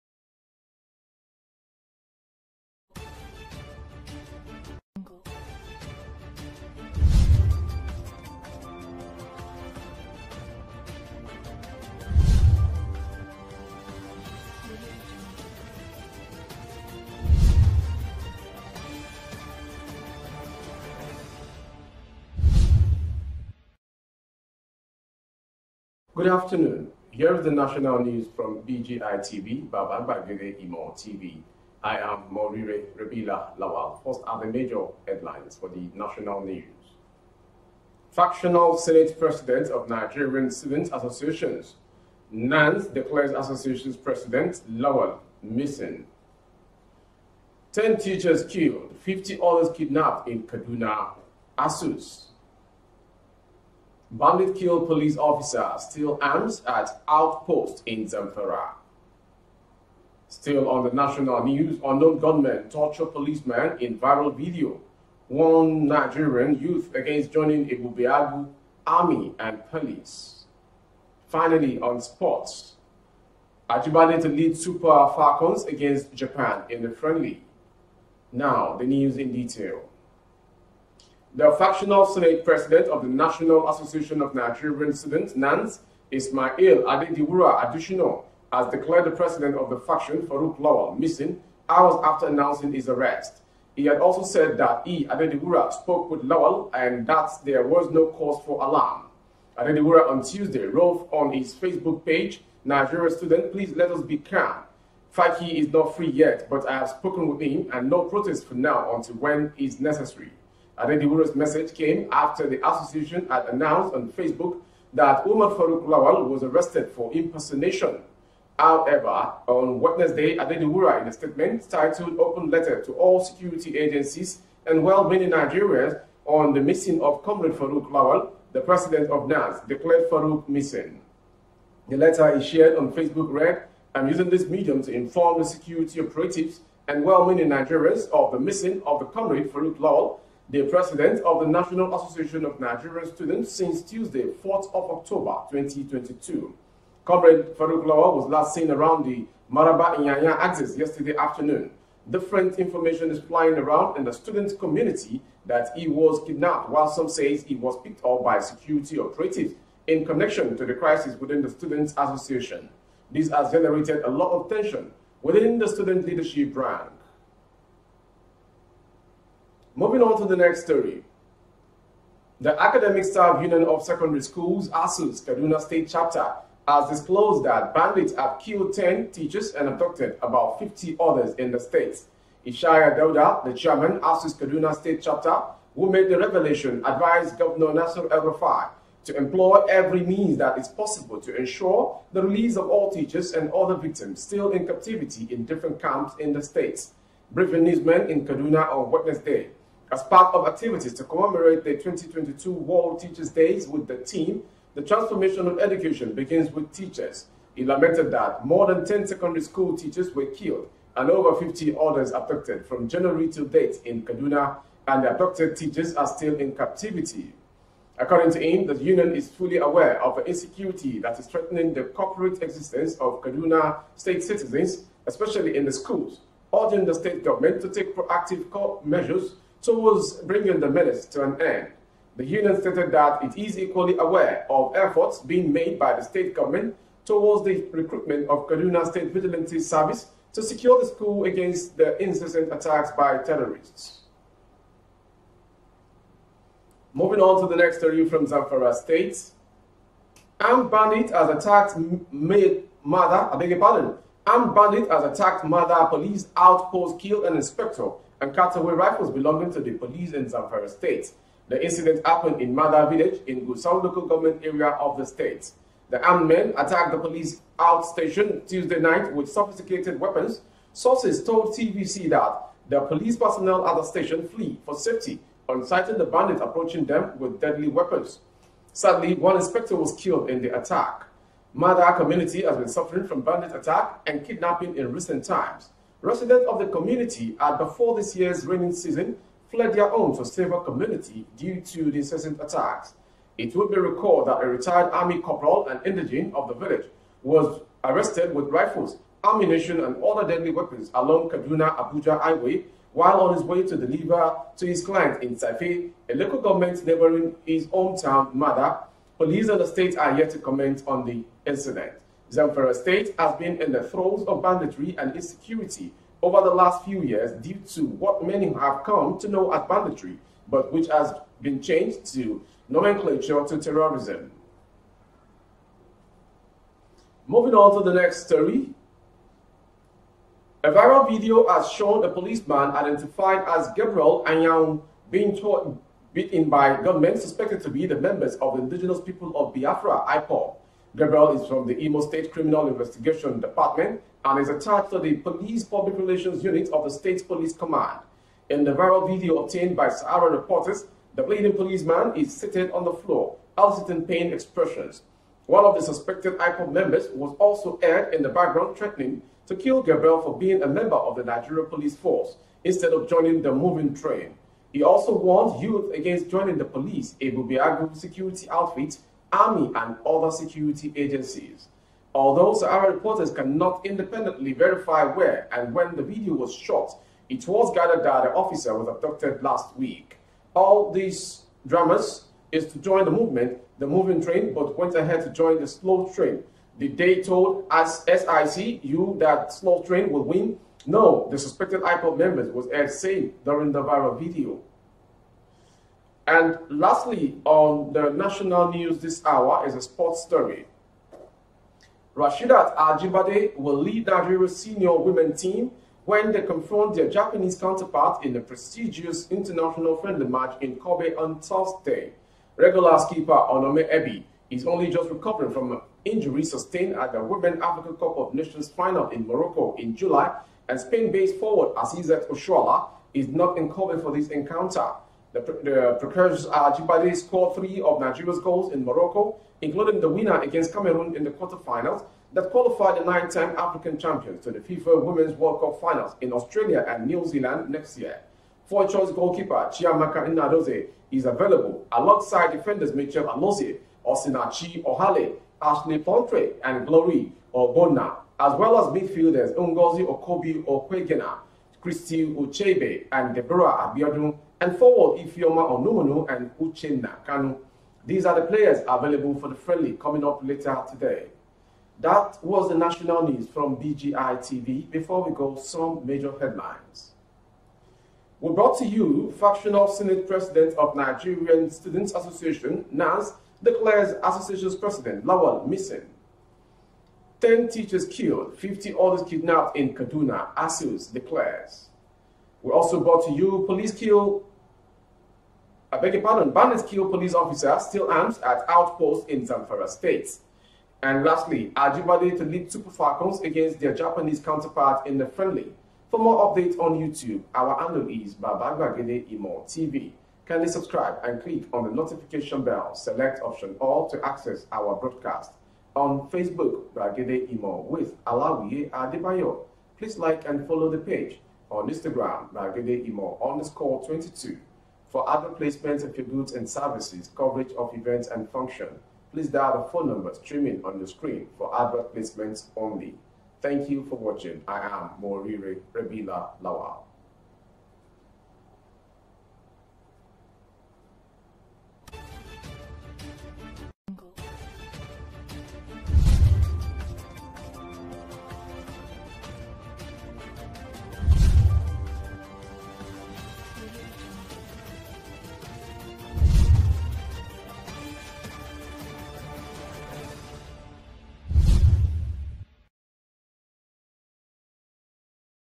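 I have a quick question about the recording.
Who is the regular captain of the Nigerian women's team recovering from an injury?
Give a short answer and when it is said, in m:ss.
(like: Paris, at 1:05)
Onome Ebi, at 6:53.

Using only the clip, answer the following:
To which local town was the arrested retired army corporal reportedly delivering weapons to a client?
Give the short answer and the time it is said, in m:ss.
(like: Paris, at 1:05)
Tsafe, at 5:05.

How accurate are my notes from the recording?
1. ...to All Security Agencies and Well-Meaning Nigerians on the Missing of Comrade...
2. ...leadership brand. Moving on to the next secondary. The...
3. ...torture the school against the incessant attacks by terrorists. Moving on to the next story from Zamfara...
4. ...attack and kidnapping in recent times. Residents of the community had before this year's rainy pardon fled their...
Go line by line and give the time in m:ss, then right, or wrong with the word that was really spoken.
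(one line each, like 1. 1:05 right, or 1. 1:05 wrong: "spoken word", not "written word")
1. 2:02 right
2. 2:46 wrong: "story", not "secondary"
3. 4:00 wrong: "secure", not "torture"
4. 4:43 wrong: "season", not "pardon".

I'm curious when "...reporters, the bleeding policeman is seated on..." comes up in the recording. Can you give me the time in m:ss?
5:50.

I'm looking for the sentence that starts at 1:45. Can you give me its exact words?
Faki is not free yet, but I have spoken with him and no protest for now until when is necessary.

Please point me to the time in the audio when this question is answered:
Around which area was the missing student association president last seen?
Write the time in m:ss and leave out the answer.
2:29.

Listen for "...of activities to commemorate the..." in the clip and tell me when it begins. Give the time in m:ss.
3:20.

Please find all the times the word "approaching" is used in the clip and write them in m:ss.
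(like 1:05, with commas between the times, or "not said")
4:36.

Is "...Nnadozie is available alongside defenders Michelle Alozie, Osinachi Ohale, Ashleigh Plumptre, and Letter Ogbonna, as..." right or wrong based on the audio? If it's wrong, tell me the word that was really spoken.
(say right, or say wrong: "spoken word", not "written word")
wrong: "Glory", not "Letter".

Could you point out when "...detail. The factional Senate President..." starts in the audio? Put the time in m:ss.
1:19.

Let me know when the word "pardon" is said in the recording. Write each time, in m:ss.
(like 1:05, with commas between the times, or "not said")
4:13, 8:06.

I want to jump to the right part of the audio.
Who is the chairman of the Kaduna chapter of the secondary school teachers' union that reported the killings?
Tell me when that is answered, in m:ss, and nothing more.
3:02.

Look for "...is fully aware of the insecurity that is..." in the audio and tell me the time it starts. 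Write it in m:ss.
3:39.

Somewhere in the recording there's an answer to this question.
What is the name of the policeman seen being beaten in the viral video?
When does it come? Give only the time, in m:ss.
5:33.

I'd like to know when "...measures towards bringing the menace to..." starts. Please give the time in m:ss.
3:48.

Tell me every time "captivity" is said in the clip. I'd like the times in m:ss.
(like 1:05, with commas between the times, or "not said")
3:14, 3:36.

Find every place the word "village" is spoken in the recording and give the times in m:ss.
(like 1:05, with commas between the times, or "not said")
4:22, 4:56.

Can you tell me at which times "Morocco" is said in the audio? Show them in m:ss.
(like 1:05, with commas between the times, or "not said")
6:59, 7:08.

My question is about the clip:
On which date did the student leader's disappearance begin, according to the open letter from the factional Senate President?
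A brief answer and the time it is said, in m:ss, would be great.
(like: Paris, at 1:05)
4th of October 2022, at 2:24.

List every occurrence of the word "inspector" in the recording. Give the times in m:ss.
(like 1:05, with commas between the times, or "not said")
4:17, 4:39.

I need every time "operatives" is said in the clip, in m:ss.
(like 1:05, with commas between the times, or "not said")
2:15, 2:38.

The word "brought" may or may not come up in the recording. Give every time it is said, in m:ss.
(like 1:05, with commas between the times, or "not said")
7:48, 8:03.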